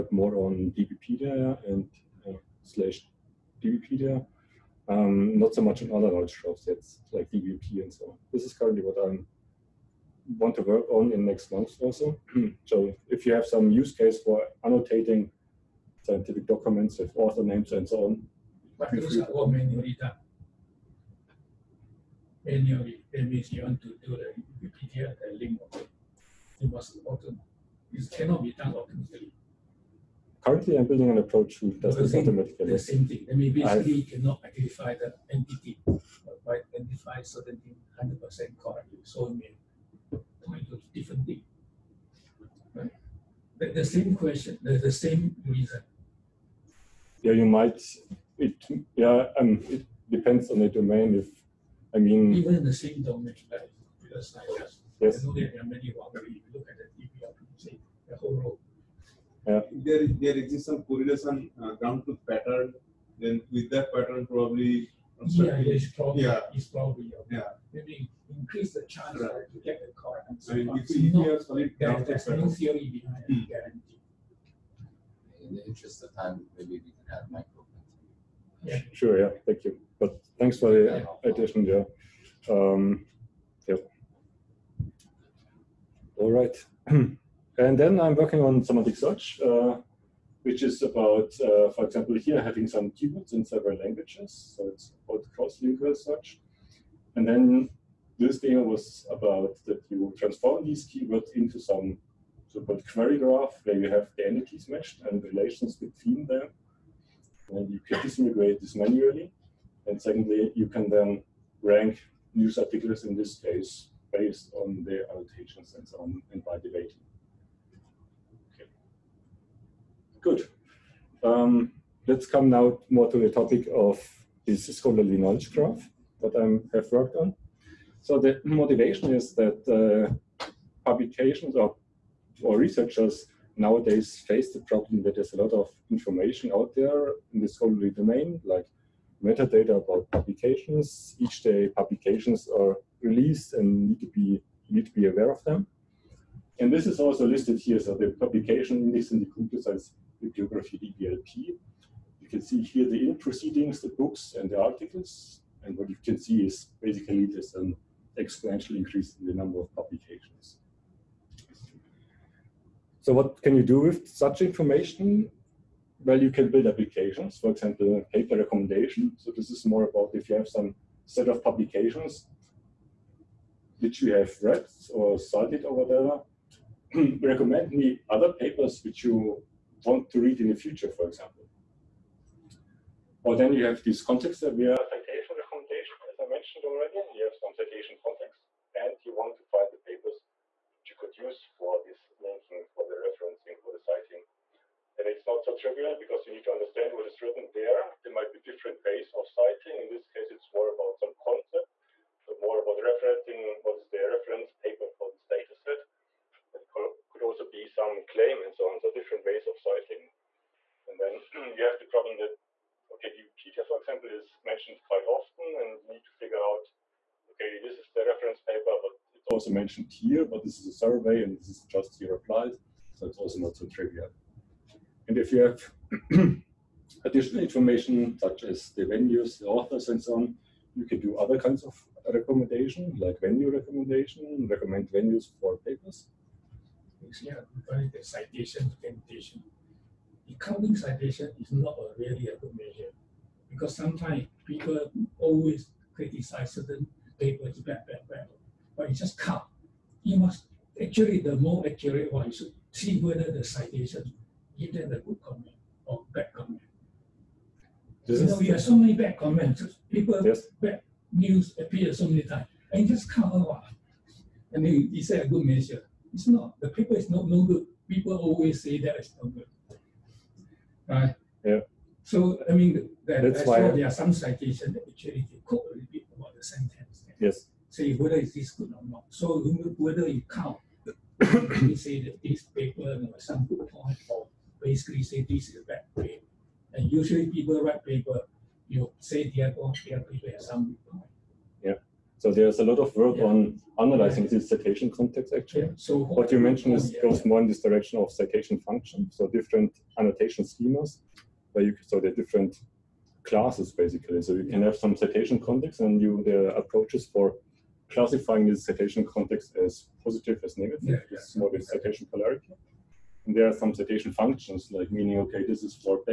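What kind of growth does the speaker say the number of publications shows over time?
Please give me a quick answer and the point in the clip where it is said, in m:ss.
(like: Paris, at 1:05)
Exponential increase, at 2:38.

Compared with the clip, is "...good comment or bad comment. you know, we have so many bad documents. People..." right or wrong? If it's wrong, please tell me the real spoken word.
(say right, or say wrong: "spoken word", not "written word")
wrong: "comments", not "documents".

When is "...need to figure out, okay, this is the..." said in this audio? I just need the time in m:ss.
3:35.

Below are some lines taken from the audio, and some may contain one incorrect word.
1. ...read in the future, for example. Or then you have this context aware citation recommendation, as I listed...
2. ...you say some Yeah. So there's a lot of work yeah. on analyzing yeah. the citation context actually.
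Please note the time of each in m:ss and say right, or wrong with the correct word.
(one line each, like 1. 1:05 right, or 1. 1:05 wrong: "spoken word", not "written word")
1. 3:00 wrong: "mentioned", not "listed"
2. 4:48 right.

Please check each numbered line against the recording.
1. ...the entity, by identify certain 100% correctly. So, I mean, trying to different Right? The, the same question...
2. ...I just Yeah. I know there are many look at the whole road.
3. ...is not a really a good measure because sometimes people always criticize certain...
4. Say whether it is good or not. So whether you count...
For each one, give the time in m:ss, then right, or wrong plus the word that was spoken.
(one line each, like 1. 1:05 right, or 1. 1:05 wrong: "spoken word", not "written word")
1. 0:34 right
2. 0:54 wrong: "Yes", not "Yeah"
3. 4:01 right
4. 4:37 right.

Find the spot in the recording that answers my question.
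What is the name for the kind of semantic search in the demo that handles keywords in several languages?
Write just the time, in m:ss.
1:35.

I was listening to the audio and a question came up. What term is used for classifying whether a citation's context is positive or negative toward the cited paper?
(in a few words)
Citation polarity.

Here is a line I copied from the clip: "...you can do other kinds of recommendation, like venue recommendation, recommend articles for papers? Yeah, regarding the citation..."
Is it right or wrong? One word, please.
wrong.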